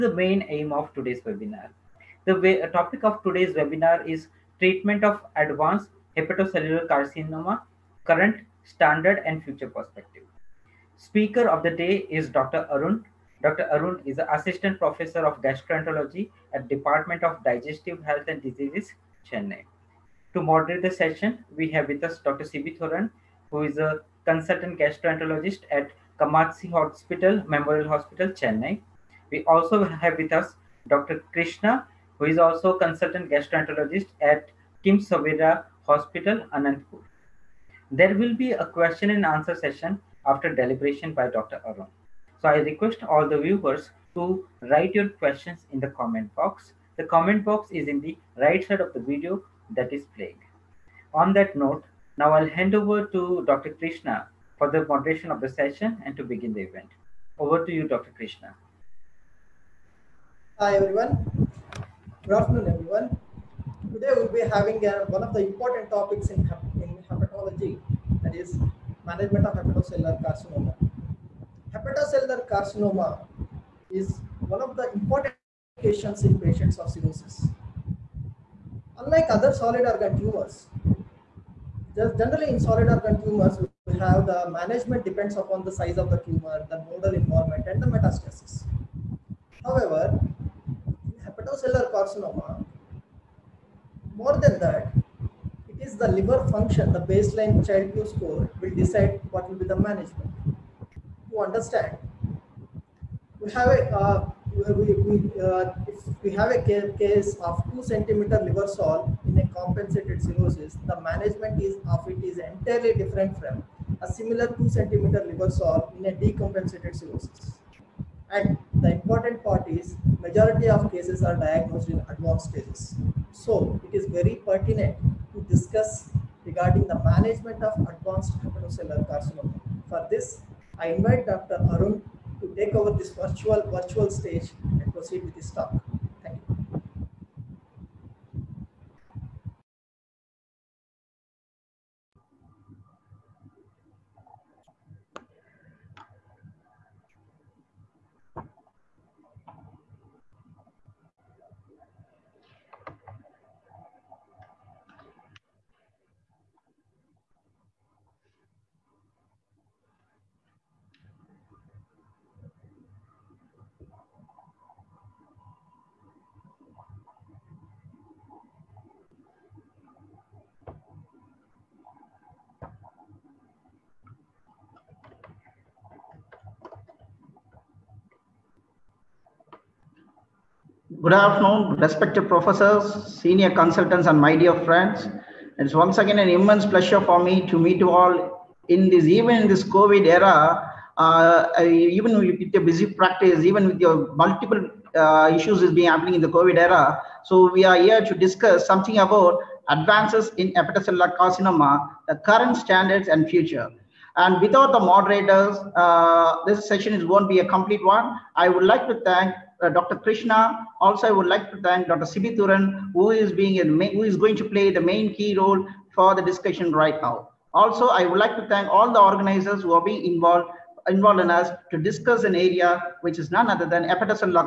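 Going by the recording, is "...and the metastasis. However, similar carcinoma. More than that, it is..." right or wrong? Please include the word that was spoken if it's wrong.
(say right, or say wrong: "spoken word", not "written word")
wrong: "hepatocellular", not "similar".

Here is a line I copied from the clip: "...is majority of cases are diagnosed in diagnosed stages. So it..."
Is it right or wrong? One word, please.
wrong.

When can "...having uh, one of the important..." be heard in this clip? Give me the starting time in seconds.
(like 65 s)
64 s.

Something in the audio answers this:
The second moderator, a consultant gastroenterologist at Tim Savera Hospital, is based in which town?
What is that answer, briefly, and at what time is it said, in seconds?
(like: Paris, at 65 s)
Anantapur, at 36 s.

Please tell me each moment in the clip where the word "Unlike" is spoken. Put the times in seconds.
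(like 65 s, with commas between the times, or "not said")
78 s.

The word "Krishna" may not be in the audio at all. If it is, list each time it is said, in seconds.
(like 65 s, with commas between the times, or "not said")
31 s, 53 s, 58 s, 209 s.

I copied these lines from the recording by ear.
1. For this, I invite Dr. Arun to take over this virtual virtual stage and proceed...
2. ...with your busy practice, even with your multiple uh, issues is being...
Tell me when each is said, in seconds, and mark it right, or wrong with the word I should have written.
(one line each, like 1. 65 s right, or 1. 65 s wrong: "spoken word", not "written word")
1. 129 s right
2. 192 s right.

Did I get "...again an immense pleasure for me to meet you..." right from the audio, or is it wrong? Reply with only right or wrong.
right.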